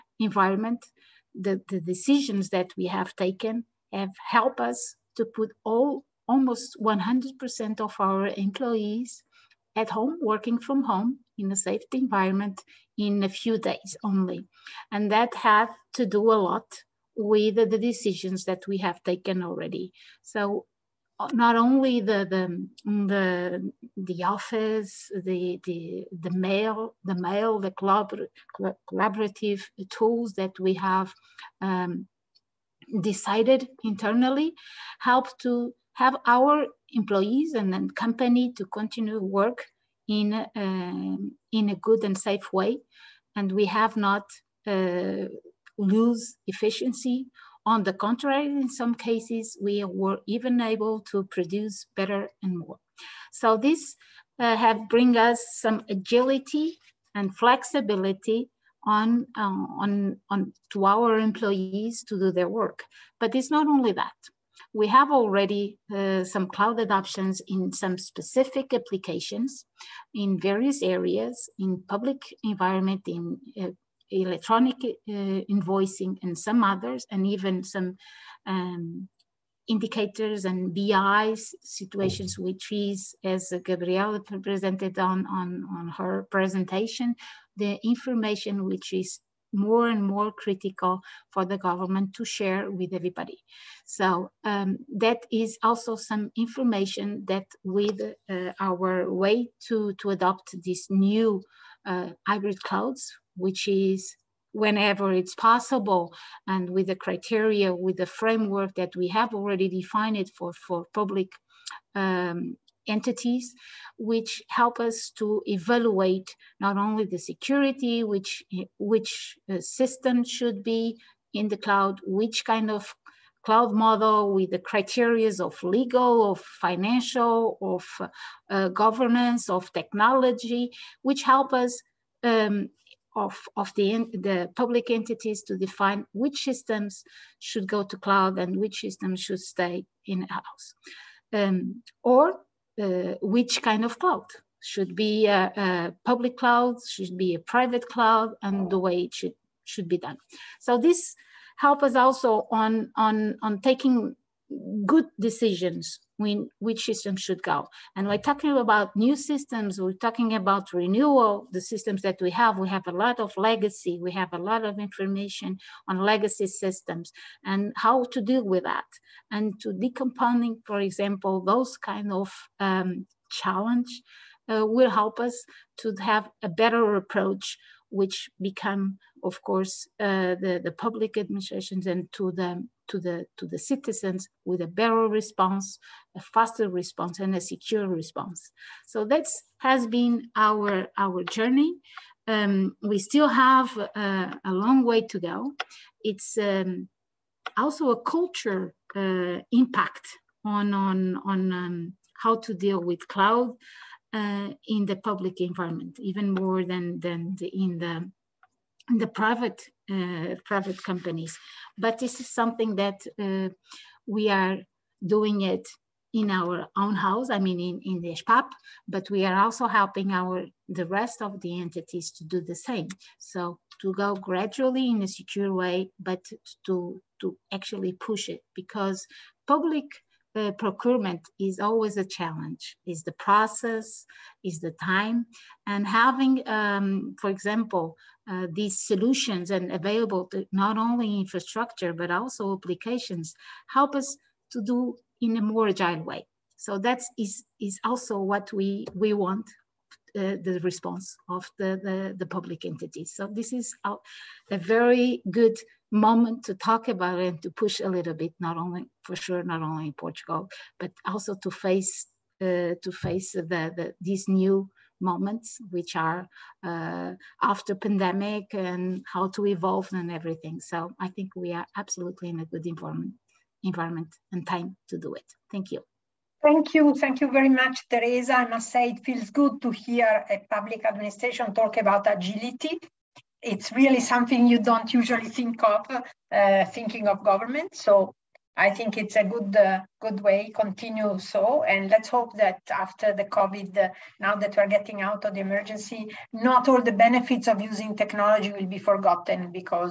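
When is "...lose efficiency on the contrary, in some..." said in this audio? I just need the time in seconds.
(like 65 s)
45 s.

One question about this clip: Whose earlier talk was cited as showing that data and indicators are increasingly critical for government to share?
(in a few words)
Gabriela.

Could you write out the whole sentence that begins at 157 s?
And we're talking about new systems, we're talking about renewal, the systems that we have.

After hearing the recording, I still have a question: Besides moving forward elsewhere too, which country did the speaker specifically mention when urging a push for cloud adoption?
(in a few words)
Portugal.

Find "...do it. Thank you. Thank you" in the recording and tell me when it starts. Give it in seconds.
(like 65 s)
274 s.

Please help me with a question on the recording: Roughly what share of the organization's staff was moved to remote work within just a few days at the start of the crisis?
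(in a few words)
almost 100%.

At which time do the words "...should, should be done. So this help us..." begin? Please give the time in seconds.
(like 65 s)
149 s.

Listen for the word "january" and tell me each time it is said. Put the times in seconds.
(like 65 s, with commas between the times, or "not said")
not said.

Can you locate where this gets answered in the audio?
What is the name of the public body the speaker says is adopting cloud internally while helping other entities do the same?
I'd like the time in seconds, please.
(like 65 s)
218 s.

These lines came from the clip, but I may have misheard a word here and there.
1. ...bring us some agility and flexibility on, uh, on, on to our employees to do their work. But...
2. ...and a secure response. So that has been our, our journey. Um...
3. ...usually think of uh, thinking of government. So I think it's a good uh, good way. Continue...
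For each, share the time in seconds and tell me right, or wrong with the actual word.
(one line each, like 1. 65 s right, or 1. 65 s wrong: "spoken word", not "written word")
1. 54 s right
2. 187 s right
3. 284 s right.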